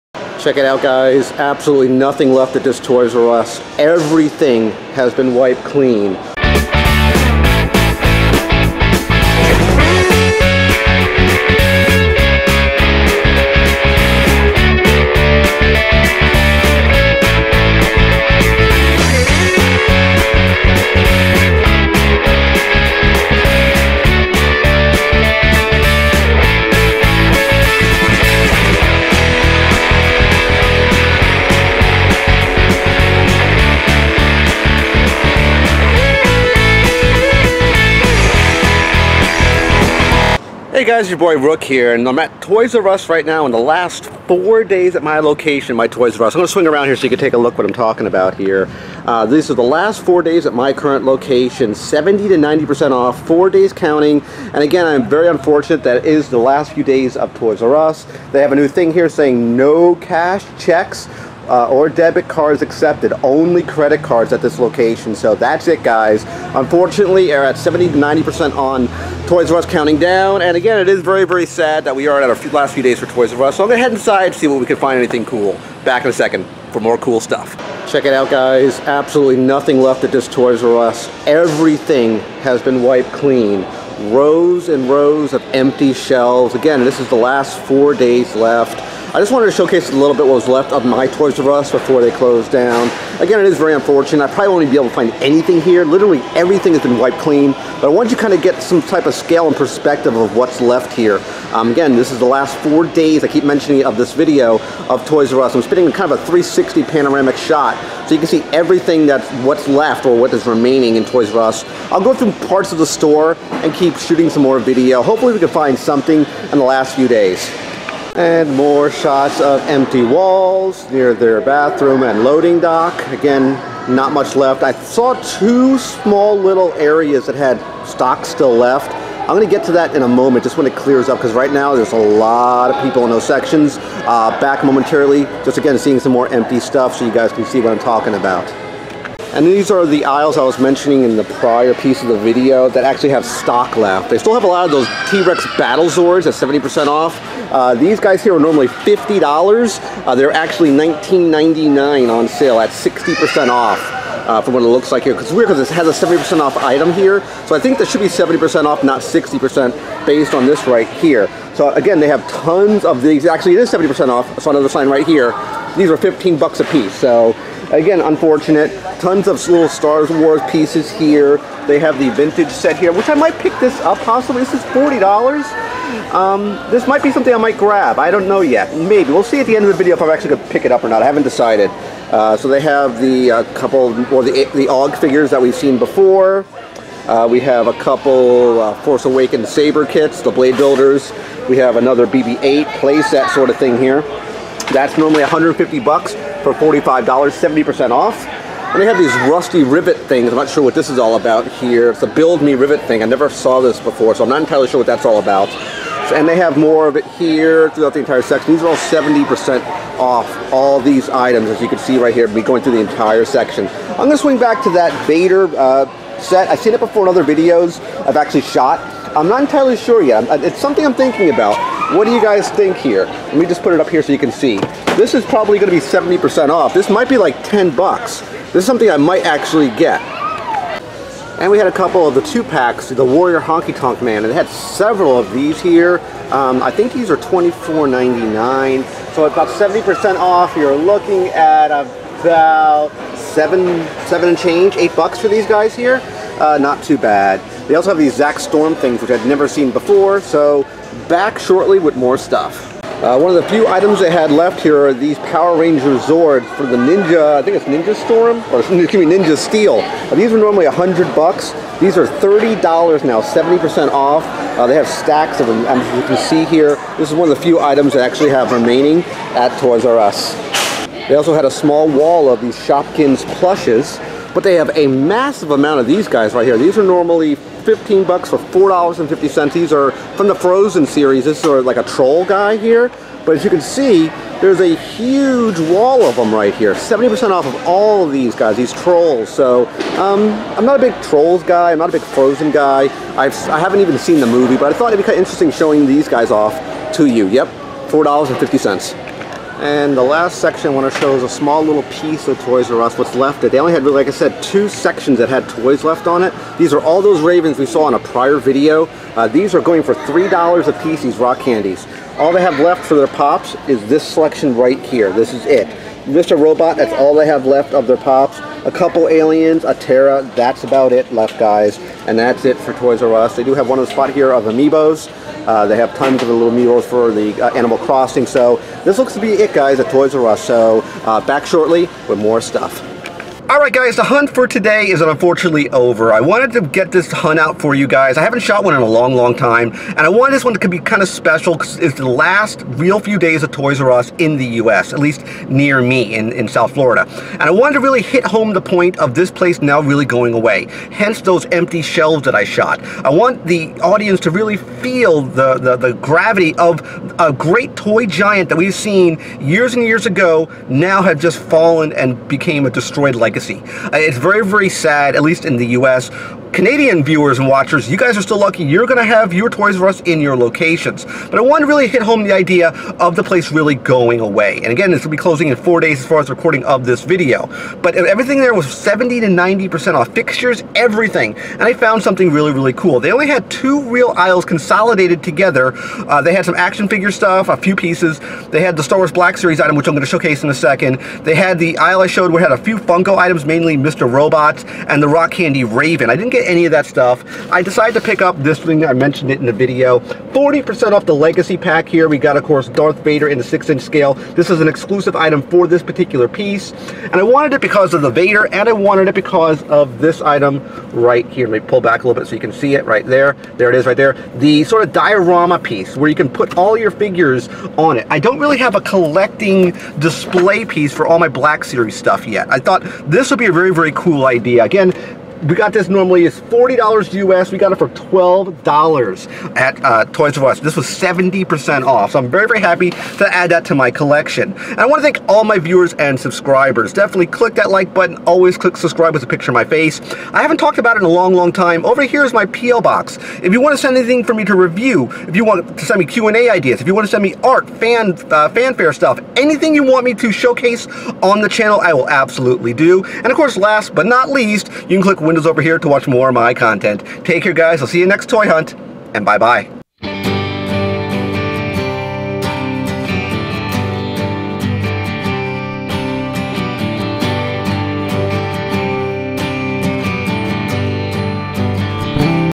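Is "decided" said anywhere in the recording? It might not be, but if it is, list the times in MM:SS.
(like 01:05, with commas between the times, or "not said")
03:01, 06:37.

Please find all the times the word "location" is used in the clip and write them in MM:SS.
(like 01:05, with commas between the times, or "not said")
00:45, 00:51, 01:04, 06:10.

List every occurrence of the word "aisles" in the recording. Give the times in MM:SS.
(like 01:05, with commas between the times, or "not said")
02:20, 06:24, 06:31.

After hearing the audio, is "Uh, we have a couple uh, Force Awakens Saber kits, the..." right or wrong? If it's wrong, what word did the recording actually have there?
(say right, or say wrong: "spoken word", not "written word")
right.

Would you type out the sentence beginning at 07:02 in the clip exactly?
I thought this this would be a very, very cool idea.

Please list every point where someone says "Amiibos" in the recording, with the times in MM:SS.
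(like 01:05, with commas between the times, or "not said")
05:24.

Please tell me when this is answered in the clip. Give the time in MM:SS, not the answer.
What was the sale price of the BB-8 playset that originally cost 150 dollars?
03:16.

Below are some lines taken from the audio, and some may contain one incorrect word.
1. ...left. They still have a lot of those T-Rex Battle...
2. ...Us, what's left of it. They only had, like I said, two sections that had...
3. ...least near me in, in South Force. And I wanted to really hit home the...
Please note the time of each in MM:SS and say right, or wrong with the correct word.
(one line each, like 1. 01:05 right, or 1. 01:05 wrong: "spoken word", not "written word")
1. 02:23 right
2. 05:02 right
3. 05:44 wrong: "Florida", not "Force".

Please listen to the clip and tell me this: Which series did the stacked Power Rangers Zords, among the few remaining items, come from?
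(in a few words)
Ninja Steel.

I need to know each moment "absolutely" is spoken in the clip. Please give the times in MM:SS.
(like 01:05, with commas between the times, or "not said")
00:01, 01:18, 07:32.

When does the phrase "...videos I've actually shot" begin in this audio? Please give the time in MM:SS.
03:37.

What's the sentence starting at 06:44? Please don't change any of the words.
This is an exclusive item for this particular piece.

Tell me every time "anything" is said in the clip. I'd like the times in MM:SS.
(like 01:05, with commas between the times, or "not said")
01:14, 01:35, 07:23, 07:29.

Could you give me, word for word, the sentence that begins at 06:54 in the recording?
The sort of diorama piece where you can put all your figures on it.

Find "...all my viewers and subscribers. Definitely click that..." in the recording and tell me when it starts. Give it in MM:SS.
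07:15.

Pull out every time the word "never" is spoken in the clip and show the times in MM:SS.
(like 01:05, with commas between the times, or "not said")
03:23, 04:09.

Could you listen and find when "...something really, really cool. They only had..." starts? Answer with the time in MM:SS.
06:22.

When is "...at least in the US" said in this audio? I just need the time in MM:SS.
06:05.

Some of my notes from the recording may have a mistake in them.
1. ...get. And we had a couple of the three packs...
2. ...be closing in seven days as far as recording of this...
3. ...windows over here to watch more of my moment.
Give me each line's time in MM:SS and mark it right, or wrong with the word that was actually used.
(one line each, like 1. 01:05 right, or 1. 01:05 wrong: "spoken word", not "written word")
1. 03:49 wrong: "two", not "three"
2. 06:15 wrong: "four", not "seven"
3. 07:35 wrong: "content", not "moment".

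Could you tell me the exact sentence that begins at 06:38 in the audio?
I mentioned it in the video.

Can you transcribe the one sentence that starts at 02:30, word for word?
Uh, they're actually $19.99 on sale at 60% off.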